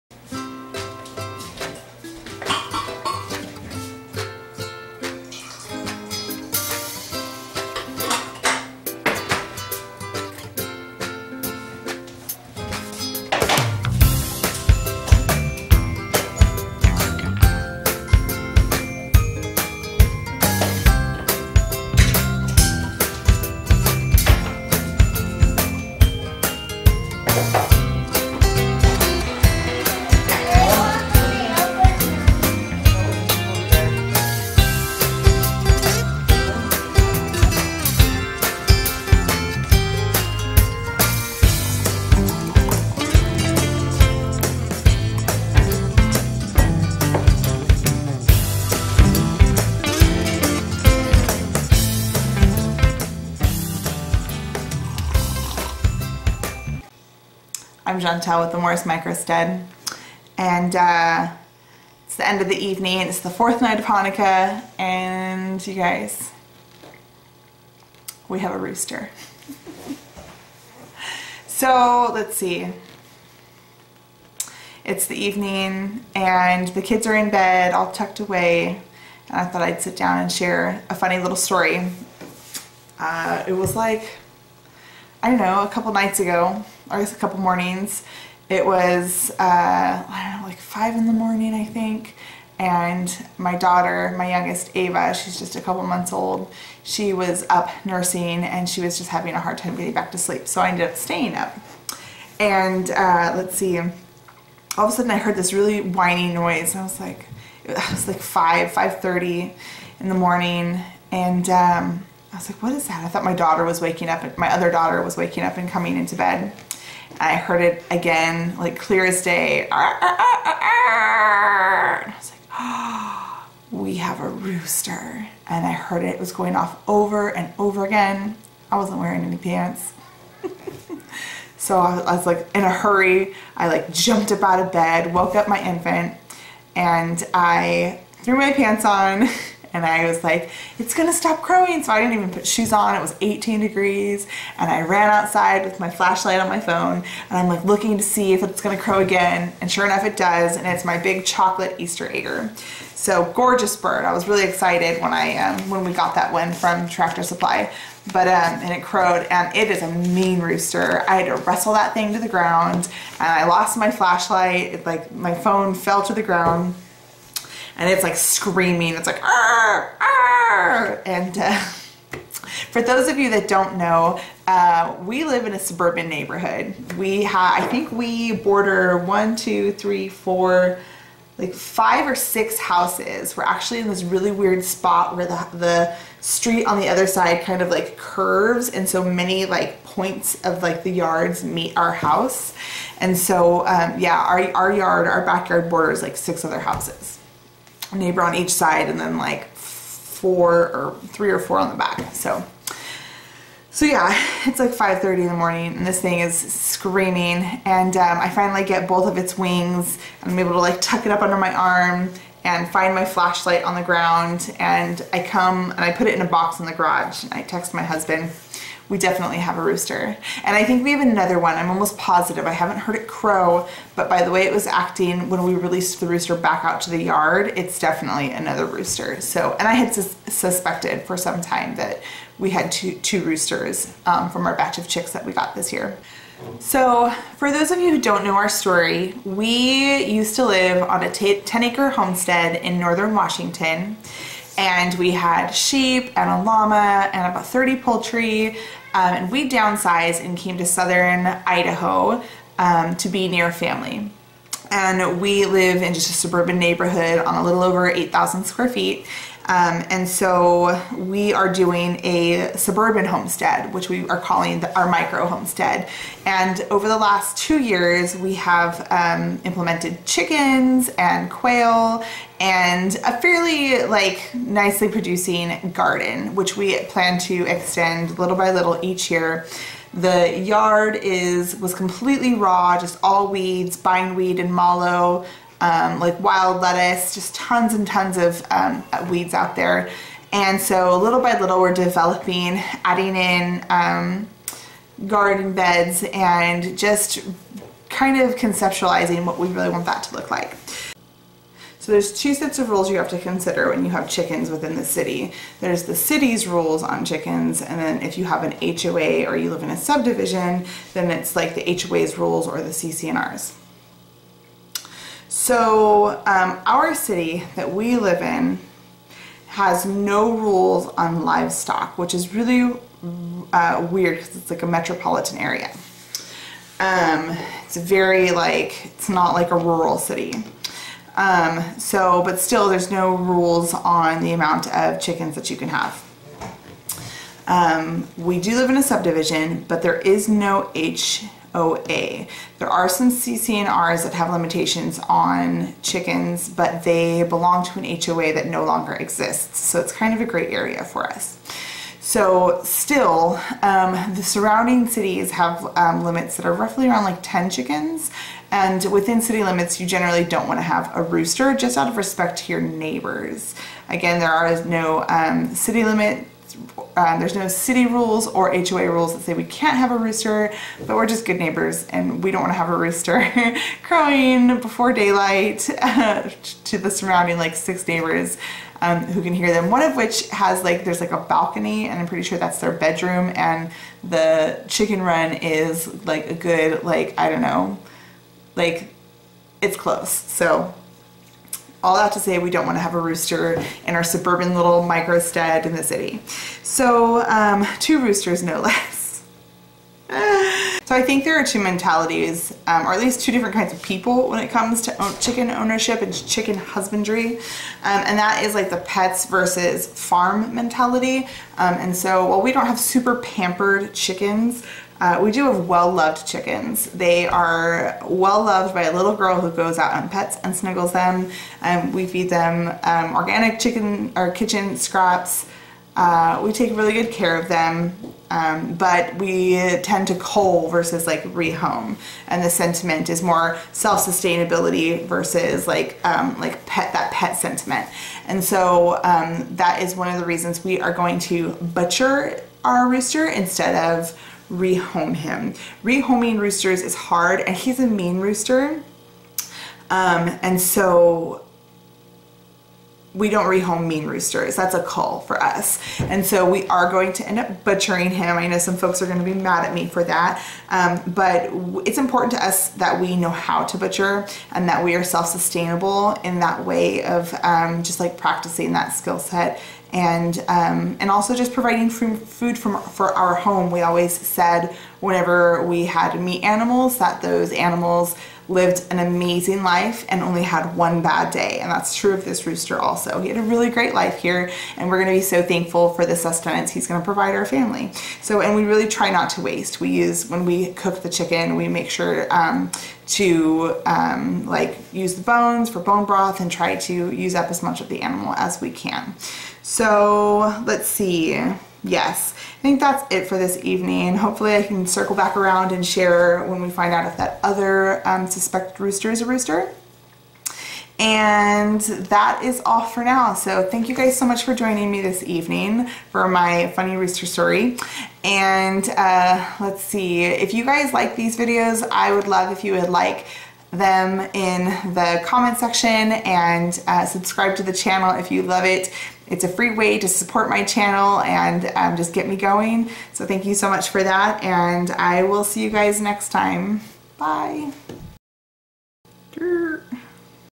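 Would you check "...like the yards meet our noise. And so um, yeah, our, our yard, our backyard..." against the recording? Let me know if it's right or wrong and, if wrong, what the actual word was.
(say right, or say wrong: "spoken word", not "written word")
wrong: "house", not "noise".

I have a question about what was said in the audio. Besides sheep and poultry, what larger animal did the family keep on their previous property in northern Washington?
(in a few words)
A llama.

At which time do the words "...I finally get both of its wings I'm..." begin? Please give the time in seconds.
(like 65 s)
208 s.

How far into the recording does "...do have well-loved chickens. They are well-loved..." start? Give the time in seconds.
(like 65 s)
415 s.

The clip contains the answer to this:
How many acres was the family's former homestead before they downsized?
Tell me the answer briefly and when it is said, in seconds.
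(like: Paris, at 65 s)
10 acres, at 241 s.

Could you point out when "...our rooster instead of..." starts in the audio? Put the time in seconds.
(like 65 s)
442 s.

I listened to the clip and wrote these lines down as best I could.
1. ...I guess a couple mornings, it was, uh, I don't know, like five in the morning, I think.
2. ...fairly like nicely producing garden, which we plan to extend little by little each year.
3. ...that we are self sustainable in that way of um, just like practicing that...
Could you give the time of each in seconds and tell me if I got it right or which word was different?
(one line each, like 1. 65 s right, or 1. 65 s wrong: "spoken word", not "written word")
1. 86 s right
2. 273 s right
3. 464 s right.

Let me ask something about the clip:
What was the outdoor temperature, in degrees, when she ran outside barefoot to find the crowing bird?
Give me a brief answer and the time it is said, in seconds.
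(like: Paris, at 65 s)
18 degrees, at 143 s.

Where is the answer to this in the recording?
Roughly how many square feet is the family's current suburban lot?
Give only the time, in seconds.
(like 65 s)
257 s.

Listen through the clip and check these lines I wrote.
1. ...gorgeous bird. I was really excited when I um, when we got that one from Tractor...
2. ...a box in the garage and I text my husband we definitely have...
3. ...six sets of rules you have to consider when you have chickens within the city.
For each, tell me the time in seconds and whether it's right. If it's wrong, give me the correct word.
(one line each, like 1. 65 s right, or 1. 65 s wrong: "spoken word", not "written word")
1. 153 s right
2. 216 s right
3. 302 s wrong: "two", not "six".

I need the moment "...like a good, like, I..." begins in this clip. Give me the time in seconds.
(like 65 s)
386 s.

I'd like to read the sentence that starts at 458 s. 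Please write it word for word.
I know some folks are going to be mad at me for that.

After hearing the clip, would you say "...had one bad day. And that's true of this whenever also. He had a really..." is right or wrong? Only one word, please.
wrong.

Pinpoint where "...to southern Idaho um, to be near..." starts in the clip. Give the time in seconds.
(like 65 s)
250 s.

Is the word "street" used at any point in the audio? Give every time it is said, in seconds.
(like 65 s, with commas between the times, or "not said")
186 s.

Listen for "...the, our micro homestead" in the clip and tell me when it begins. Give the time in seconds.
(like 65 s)
264 s.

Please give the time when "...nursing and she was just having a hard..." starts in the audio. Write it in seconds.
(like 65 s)
97 s.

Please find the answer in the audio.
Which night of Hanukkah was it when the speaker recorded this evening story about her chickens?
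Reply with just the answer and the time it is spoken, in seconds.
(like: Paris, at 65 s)
Fourth night, at 63 s.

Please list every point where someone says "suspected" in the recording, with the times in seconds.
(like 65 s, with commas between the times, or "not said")
230 s, 508 s.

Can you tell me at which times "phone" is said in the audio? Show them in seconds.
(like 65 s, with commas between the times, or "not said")
146 s, 165 s.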